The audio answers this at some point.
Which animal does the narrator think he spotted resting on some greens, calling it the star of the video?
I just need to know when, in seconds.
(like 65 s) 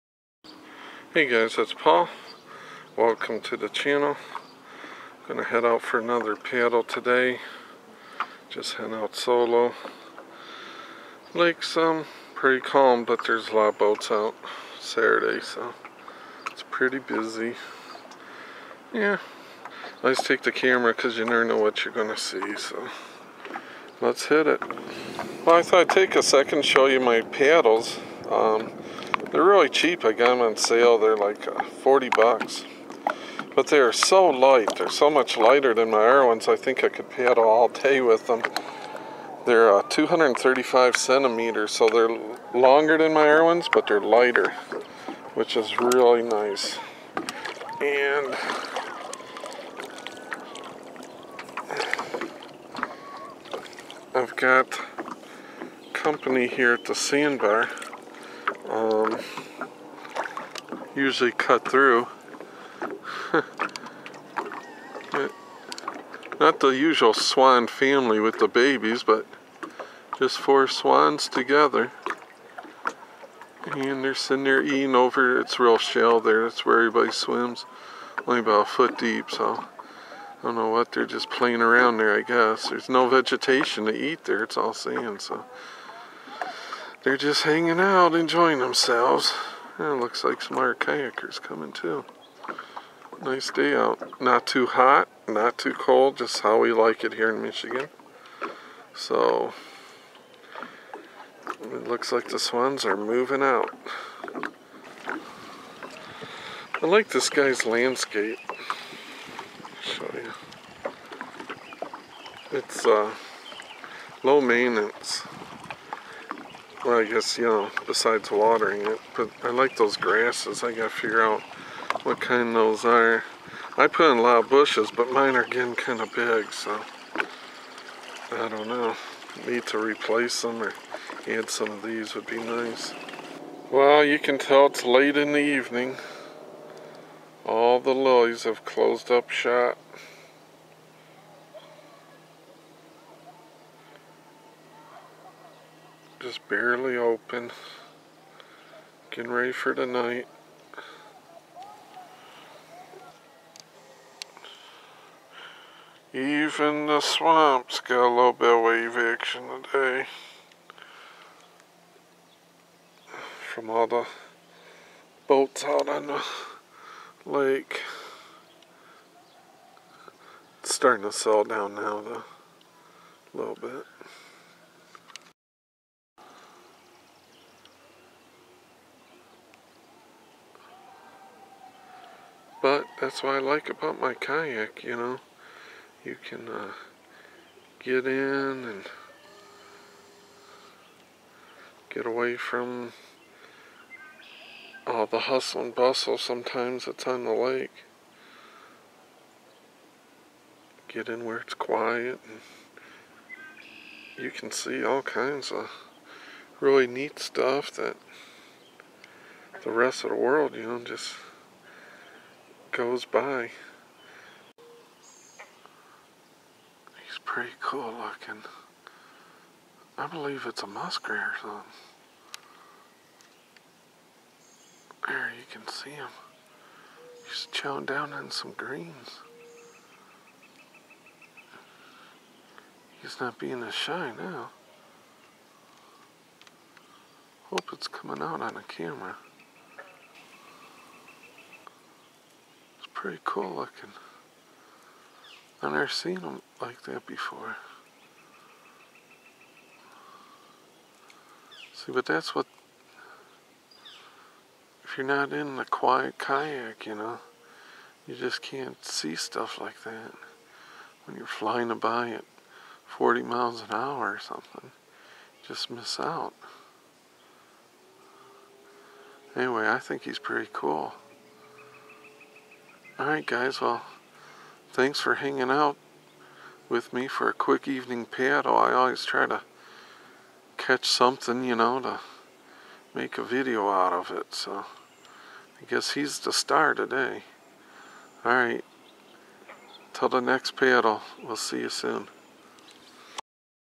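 220 s.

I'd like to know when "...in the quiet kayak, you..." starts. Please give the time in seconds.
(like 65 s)
255 s.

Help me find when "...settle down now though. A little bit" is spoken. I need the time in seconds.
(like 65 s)
171 s.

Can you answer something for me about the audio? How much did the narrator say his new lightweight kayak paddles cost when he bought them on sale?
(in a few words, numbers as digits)
$40.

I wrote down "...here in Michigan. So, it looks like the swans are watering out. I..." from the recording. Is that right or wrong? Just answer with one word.
wrong.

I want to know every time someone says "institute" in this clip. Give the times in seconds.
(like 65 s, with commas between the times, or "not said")
not said.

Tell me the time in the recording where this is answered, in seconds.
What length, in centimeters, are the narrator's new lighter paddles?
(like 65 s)
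39 s.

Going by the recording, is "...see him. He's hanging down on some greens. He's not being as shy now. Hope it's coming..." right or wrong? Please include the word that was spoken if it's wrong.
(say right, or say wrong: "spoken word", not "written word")
wrong: "chilling", not "hanging".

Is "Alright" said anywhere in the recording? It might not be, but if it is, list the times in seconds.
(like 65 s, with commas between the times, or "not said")
273 s, 288 s.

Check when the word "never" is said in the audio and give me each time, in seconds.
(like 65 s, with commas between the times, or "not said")
21 s, 245 s.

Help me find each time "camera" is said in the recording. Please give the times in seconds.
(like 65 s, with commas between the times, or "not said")
20 s, 238 s.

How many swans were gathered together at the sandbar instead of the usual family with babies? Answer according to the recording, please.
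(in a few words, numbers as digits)
4.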